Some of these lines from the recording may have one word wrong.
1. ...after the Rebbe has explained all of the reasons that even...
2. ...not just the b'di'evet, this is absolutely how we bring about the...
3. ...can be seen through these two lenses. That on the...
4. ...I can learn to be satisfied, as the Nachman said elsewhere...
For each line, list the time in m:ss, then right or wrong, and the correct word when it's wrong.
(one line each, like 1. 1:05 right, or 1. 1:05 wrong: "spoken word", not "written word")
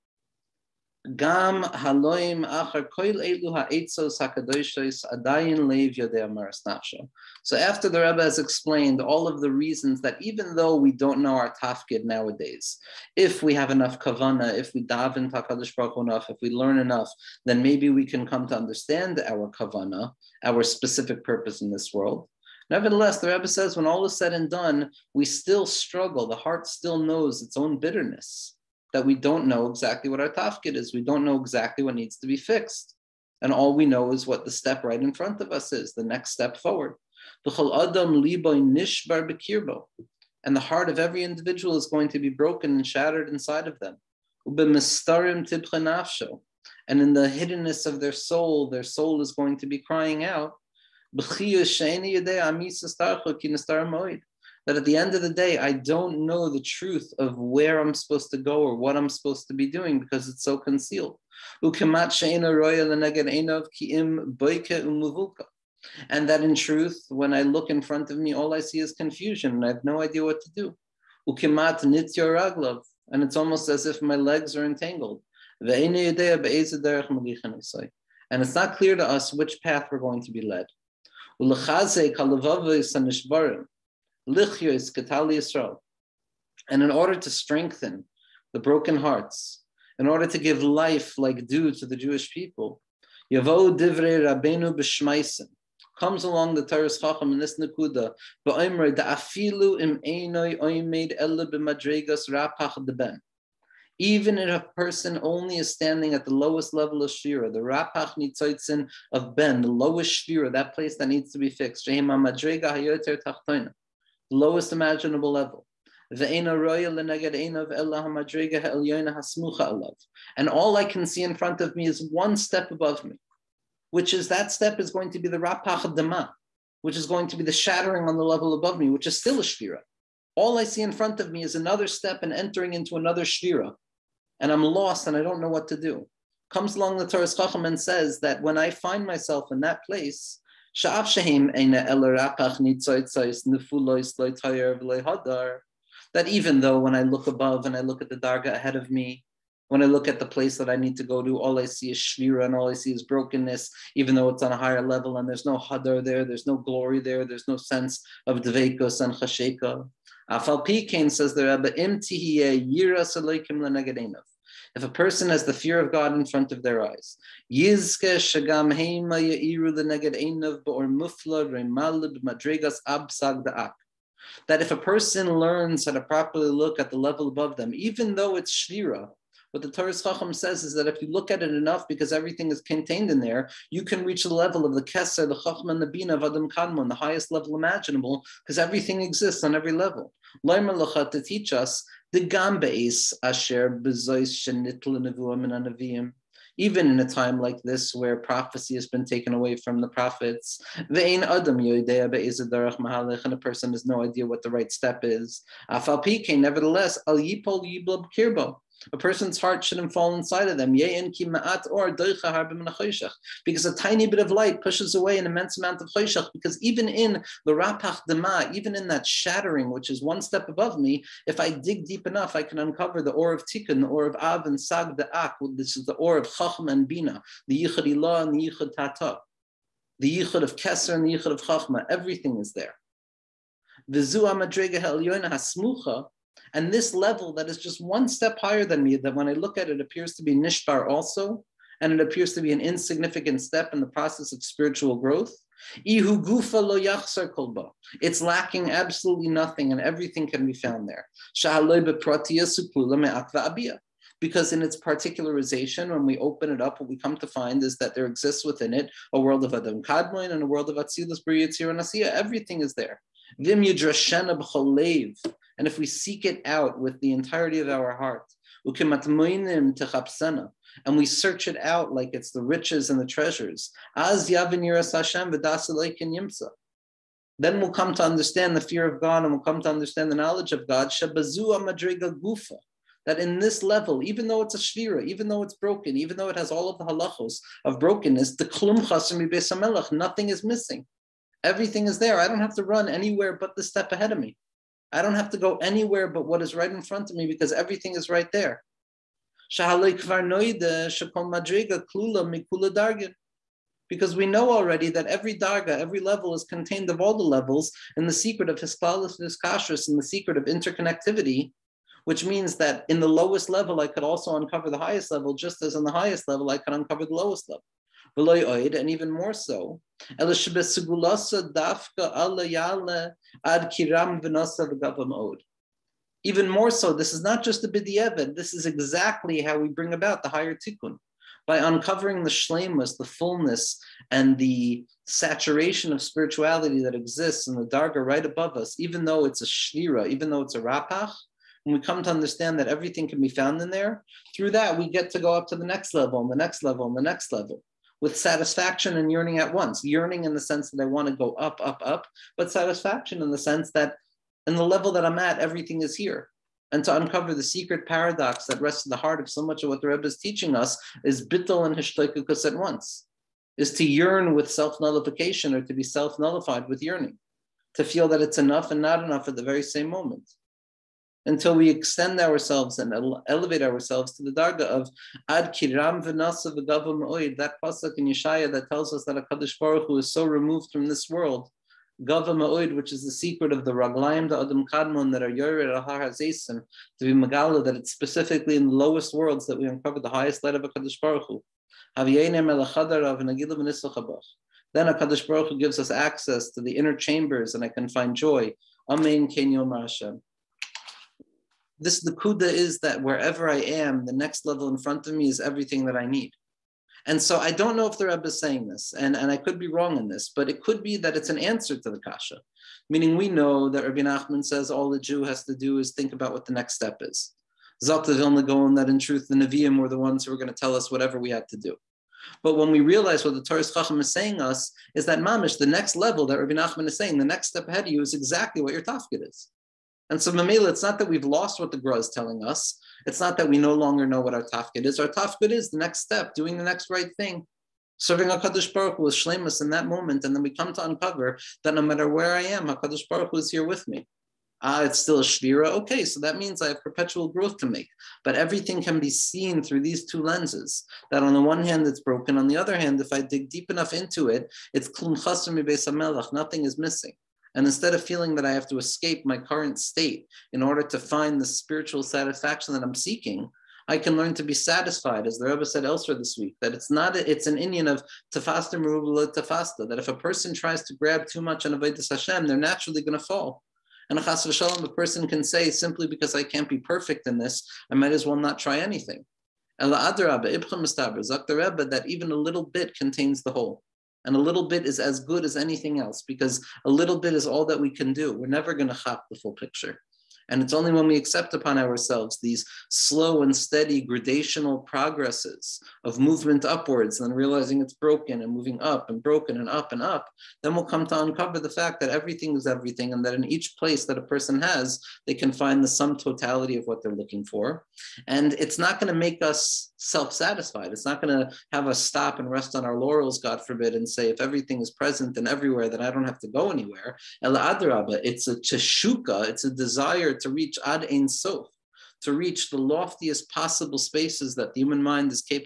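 1. 0:07 right
2. 5:27 wrong: "exactly", not "absolutely"
3. 7:28 right
4. 7:43 wrong: "Rebbe", not "Nachman".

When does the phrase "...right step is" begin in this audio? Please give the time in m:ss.
3:24.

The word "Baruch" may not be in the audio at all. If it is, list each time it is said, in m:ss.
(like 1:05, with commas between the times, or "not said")
0:15, 6:19, 6:31, 6:35, 7:18, 7:23.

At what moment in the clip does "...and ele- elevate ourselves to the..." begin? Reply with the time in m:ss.
6:12.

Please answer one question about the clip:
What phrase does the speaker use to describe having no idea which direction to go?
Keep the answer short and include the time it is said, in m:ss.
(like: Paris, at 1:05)
legs are entangled, at 1:14.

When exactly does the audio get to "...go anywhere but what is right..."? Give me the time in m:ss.
4:55.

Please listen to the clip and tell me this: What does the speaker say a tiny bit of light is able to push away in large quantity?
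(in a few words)
choshech.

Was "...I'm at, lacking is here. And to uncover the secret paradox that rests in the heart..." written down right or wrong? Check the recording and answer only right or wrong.
wrong.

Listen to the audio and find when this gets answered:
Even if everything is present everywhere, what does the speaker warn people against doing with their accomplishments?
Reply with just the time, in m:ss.
8:32.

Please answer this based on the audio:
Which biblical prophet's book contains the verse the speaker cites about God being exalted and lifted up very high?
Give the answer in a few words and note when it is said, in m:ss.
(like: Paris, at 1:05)
Yeshaya, at 6:18.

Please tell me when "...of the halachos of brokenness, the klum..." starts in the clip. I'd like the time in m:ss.
4:46.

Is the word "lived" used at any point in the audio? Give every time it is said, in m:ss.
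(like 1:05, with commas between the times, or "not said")
not said.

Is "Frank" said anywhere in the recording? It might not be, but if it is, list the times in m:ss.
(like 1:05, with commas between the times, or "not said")
not said.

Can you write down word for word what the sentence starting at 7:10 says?
And so, Mamela, it's not that we've lost what the Gra is telling us.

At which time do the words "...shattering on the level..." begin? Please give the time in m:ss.
2:07.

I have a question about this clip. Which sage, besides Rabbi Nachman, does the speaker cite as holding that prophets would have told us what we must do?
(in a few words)
Vilna Gaon.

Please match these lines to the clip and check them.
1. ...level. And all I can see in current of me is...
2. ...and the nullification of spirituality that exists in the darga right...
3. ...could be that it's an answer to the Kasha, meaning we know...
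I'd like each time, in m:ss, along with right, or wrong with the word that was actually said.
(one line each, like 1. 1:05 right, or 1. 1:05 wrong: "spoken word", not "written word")
1. 1:55 wrong: "front", not "current"
2. 5:34 wrong: "saturation", not "nullification"
3. 6:50 right.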